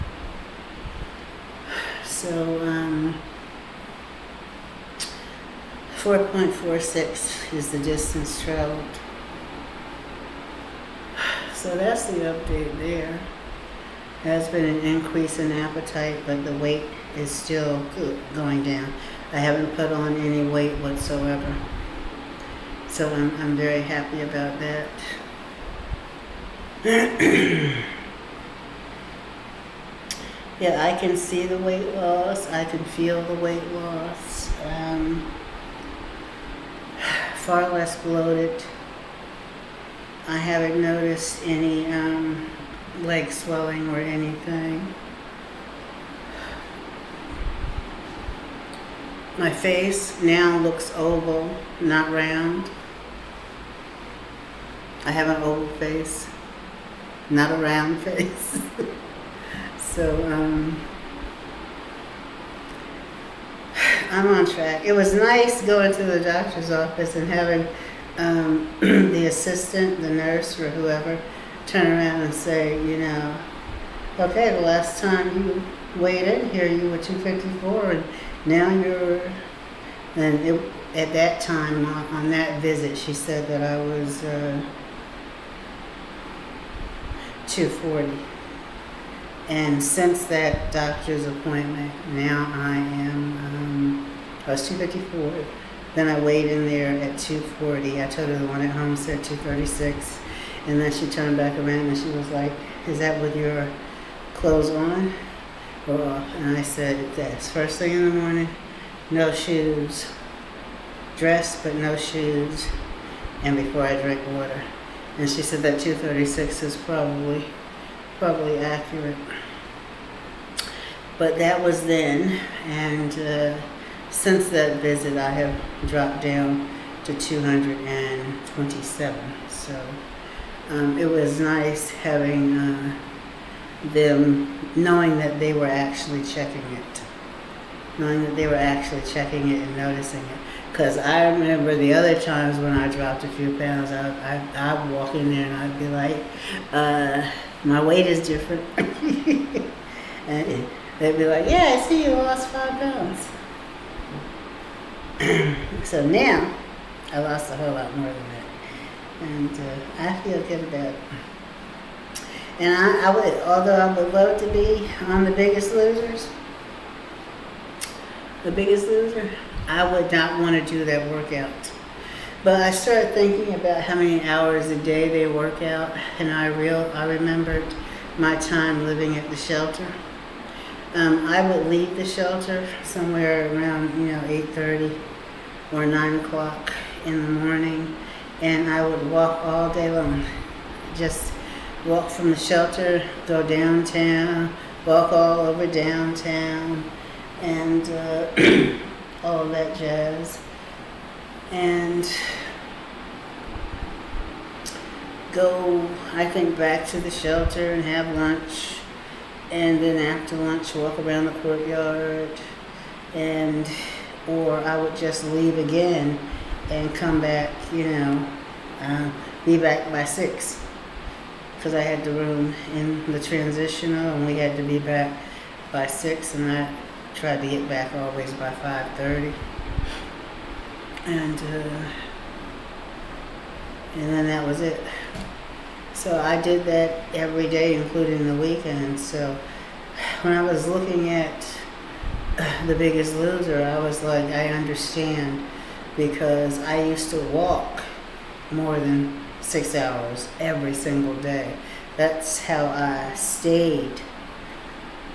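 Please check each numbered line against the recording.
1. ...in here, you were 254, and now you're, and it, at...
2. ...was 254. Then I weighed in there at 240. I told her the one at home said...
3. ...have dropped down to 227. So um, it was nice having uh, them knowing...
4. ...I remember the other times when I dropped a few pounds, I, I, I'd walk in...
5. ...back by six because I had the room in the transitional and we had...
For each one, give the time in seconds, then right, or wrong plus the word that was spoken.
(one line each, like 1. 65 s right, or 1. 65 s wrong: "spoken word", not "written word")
1. 76 s right
2. 94 s right
3. 125 s right
4. 140 s right
5. 219 s right.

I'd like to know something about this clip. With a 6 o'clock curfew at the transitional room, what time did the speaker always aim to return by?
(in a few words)
5:30.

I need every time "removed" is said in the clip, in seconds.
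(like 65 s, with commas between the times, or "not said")
not said.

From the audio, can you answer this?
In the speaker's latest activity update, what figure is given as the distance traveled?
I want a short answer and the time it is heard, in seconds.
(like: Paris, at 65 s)
4.46, at 5 s.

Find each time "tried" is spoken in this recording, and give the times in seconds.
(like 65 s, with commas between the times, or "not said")
227 s.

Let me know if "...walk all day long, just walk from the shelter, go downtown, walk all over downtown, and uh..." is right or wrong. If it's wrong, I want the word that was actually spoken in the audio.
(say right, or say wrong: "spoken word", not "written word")
right.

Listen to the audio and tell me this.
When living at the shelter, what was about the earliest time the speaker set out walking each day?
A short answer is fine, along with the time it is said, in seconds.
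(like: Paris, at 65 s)
8:30, at 184 s.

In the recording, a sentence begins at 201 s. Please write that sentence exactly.
And go, I think, back to the shelter and have lunch.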